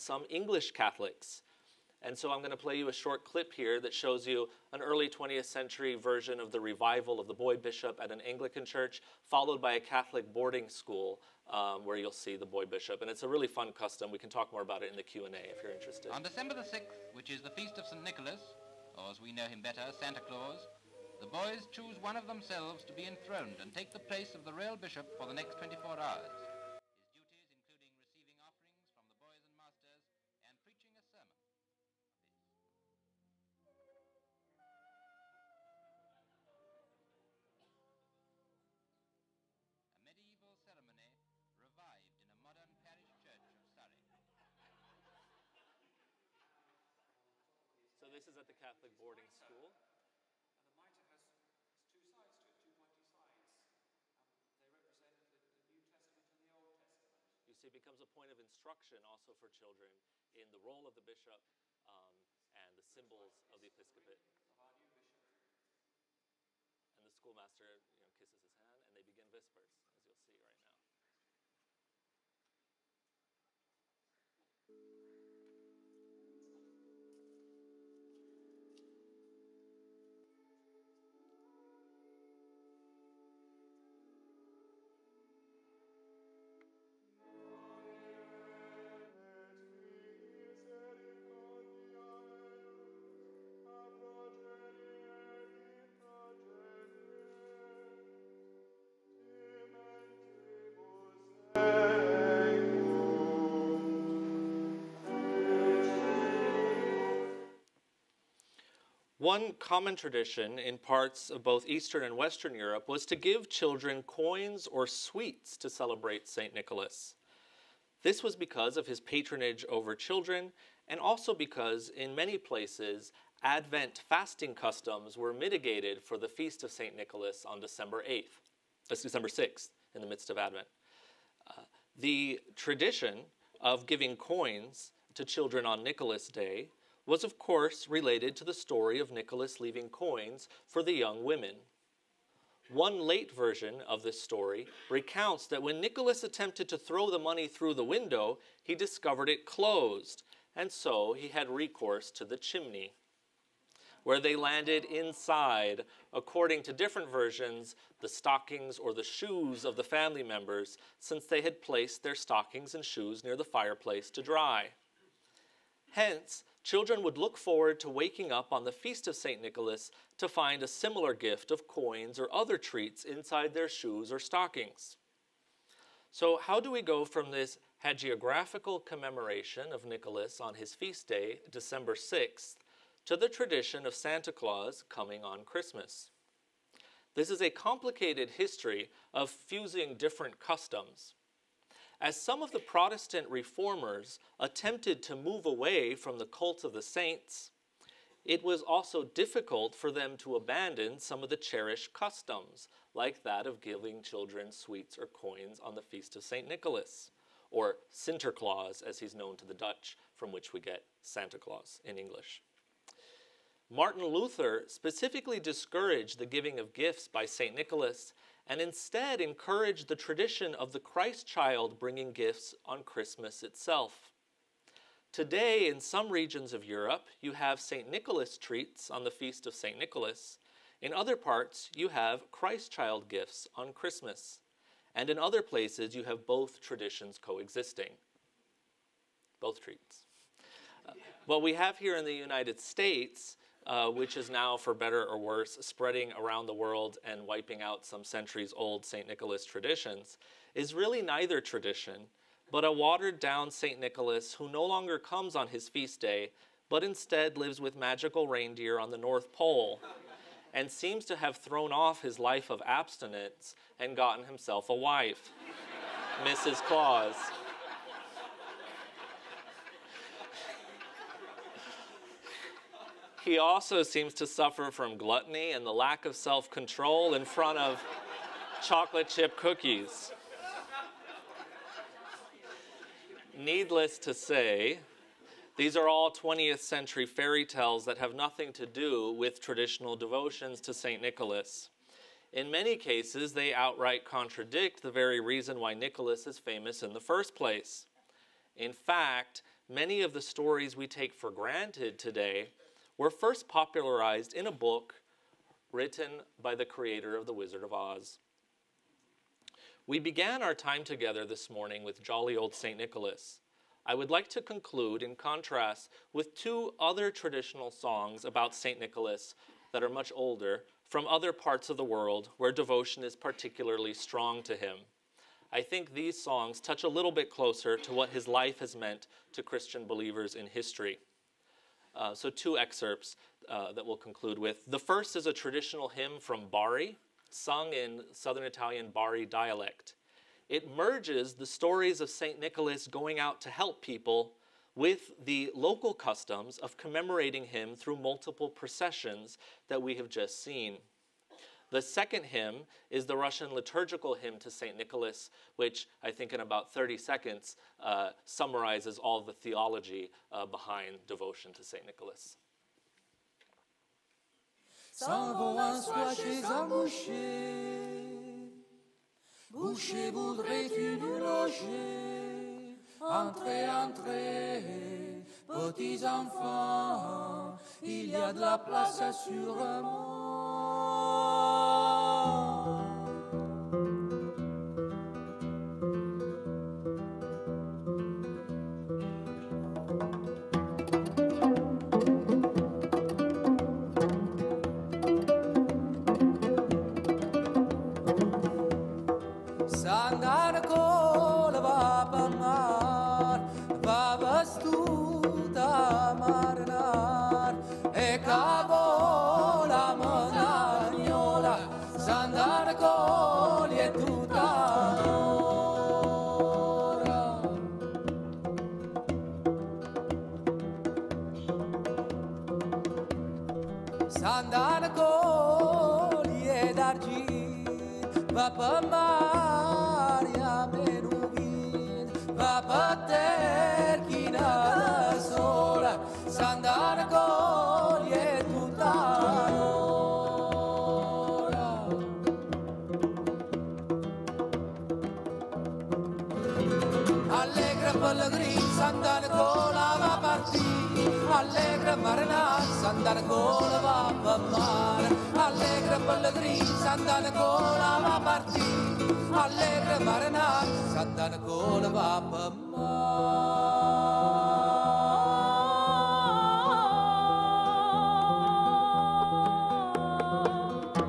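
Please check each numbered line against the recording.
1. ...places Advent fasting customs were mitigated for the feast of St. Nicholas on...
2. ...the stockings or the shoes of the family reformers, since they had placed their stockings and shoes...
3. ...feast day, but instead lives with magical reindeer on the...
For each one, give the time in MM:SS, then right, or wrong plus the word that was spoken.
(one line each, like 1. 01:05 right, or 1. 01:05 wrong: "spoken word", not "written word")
1. 02:02 right
2. 02:37 wrong: "members", not "reformers"
3. 04:15 right.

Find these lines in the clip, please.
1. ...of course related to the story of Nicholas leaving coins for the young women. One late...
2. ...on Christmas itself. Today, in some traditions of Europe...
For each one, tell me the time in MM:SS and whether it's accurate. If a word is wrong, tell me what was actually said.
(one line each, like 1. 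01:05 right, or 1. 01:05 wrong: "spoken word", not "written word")
1. 02:17 right
2. 03:42 wrong: "regions", not "traditions".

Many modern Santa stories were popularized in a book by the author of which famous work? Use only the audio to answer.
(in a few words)
The Wizard of Oz.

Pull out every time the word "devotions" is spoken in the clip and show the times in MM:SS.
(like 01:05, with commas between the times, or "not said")
04:49, 05:22.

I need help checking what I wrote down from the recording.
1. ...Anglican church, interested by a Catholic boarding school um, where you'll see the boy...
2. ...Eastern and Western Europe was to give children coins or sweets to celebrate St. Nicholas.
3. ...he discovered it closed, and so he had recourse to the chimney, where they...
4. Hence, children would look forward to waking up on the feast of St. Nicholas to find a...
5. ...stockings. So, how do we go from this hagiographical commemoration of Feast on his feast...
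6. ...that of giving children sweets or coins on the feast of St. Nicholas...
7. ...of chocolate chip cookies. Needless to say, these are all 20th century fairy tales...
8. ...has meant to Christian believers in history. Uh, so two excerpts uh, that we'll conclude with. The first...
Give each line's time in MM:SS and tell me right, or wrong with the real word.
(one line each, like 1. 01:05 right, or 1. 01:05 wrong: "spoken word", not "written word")
1. 00:08 wrong: "followed", not "interested"
2. 01:51 right
3. 02:28 right
4. 02:45 right
5. 02:54 wrong: "Nicholas", not "Feast"
6. 03:23 right
7. 04:37 right
8. 05:28 right.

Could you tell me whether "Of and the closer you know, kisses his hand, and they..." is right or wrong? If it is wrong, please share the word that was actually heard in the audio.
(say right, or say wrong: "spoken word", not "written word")
wrong: "schoolmaster", not "closer".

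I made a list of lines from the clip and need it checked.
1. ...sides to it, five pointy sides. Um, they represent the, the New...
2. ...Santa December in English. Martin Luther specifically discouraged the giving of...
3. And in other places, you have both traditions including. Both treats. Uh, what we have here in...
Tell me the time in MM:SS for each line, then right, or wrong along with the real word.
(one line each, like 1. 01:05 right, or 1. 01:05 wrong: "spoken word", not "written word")
1. 00:51 wrong: "two", not "five"
2. 03:31 wrong: "Claus", not "December"
3. 03:54 wrong: "coexisting", not "including".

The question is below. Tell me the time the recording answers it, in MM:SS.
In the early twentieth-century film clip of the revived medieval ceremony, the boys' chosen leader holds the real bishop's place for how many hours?
00:25.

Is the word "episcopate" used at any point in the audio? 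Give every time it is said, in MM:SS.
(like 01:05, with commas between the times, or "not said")
01:03.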